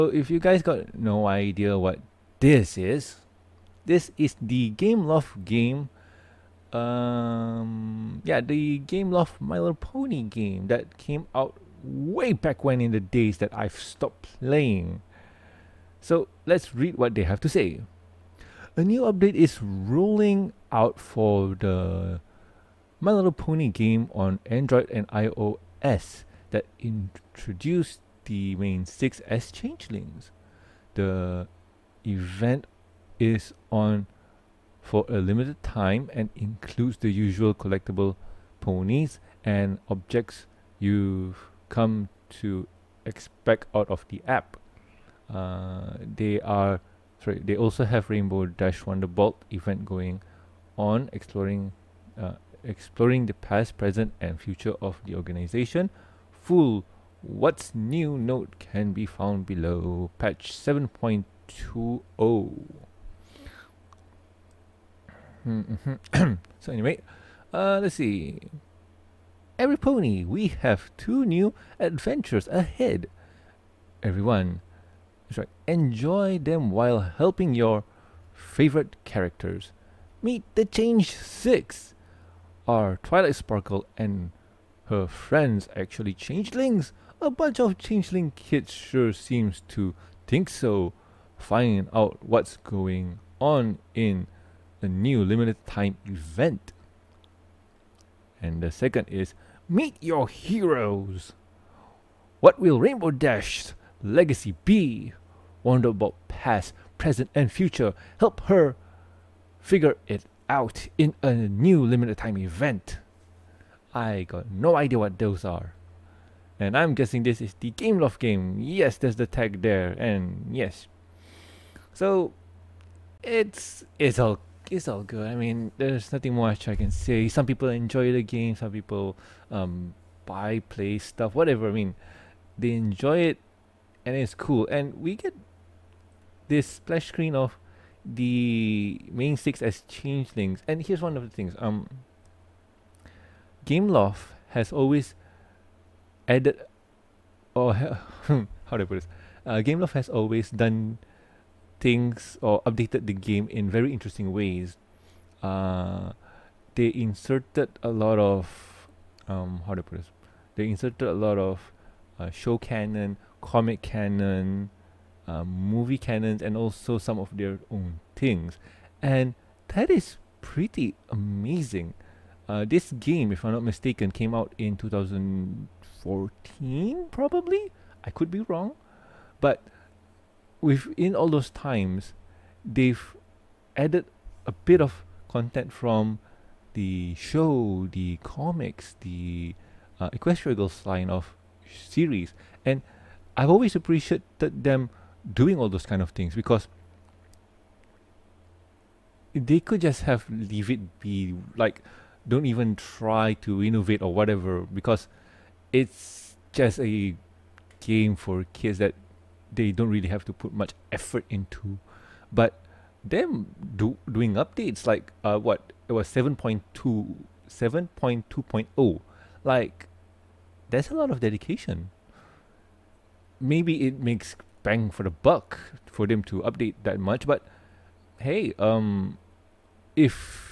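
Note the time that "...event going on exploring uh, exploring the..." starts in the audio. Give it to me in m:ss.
0:49.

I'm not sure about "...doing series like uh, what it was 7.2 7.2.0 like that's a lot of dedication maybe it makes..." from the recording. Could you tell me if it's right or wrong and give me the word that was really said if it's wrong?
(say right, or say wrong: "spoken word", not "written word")
wrong: "updates", not "series".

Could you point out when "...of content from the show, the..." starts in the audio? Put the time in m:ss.
3:04.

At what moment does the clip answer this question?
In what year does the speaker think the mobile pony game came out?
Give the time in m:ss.
2:54.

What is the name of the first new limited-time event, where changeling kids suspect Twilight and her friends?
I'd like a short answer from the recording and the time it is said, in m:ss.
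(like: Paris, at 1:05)
Meet the Change Six, at 1:20.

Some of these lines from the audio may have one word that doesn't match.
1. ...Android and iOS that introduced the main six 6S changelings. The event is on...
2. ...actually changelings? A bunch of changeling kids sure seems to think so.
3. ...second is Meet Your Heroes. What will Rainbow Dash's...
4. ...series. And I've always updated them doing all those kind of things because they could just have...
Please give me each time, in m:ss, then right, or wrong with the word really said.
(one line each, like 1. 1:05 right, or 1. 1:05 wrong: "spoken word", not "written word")
1. 0:24 right
2. 1:25 right
3. 1:38 right
4. 3:11 wrong: "appreciated", not "updated".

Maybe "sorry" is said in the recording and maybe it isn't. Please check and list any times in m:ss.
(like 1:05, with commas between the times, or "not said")
0:47, 1:15.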